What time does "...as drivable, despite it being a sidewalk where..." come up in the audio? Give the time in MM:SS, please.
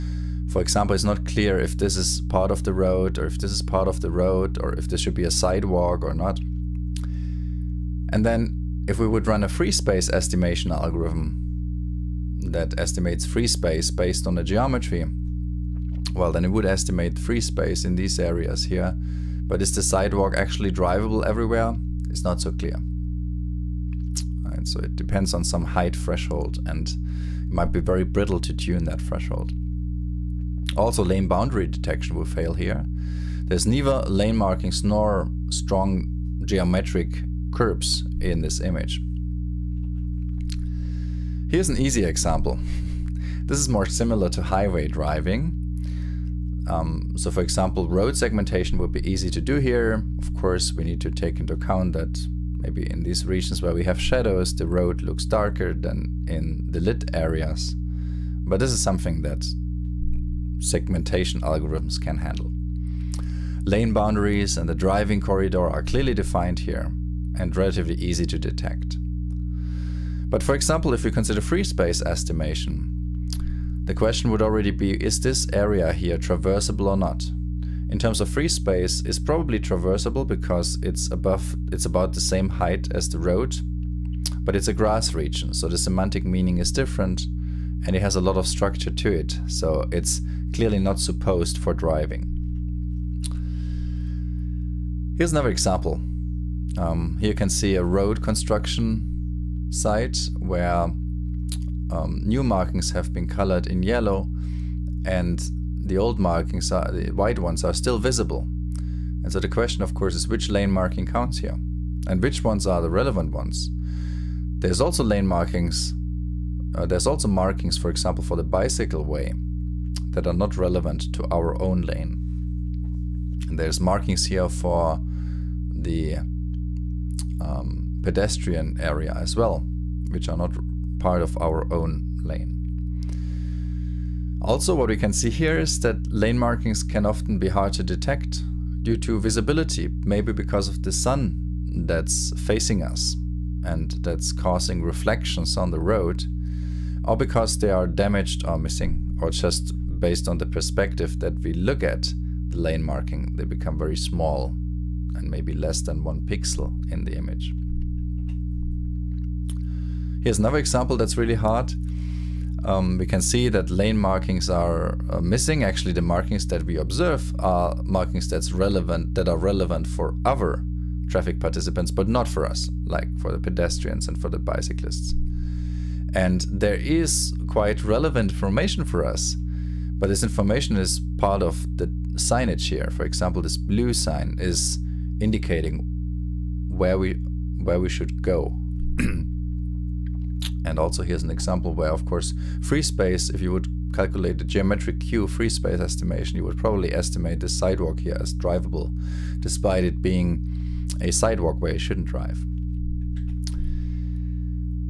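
03:18.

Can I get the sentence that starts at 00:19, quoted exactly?
But is the sidewalk actually drivable everywhere?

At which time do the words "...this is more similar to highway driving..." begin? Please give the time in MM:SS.
00:43.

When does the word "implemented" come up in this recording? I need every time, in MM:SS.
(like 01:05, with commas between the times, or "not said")
not said.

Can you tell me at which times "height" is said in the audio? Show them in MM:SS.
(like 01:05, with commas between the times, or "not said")
00:25, 01:22.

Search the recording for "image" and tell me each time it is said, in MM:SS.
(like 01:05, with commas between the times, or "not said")
00:38, 02:37.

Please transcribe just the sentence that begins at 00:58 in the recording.
But this is something that segmentation algorithms can handle.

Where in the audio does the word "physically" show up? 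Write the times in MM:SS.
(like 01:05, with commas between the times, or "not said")
not said.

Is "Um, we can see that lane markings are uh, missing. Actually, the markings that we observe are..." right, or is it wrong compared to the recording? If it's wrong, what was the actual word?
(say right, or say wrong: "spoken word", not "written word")
right.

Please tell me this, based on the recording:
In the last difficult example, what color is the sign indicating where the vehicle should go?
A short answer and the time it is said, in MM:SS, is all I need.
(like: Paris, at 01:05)
blue, at 03:03.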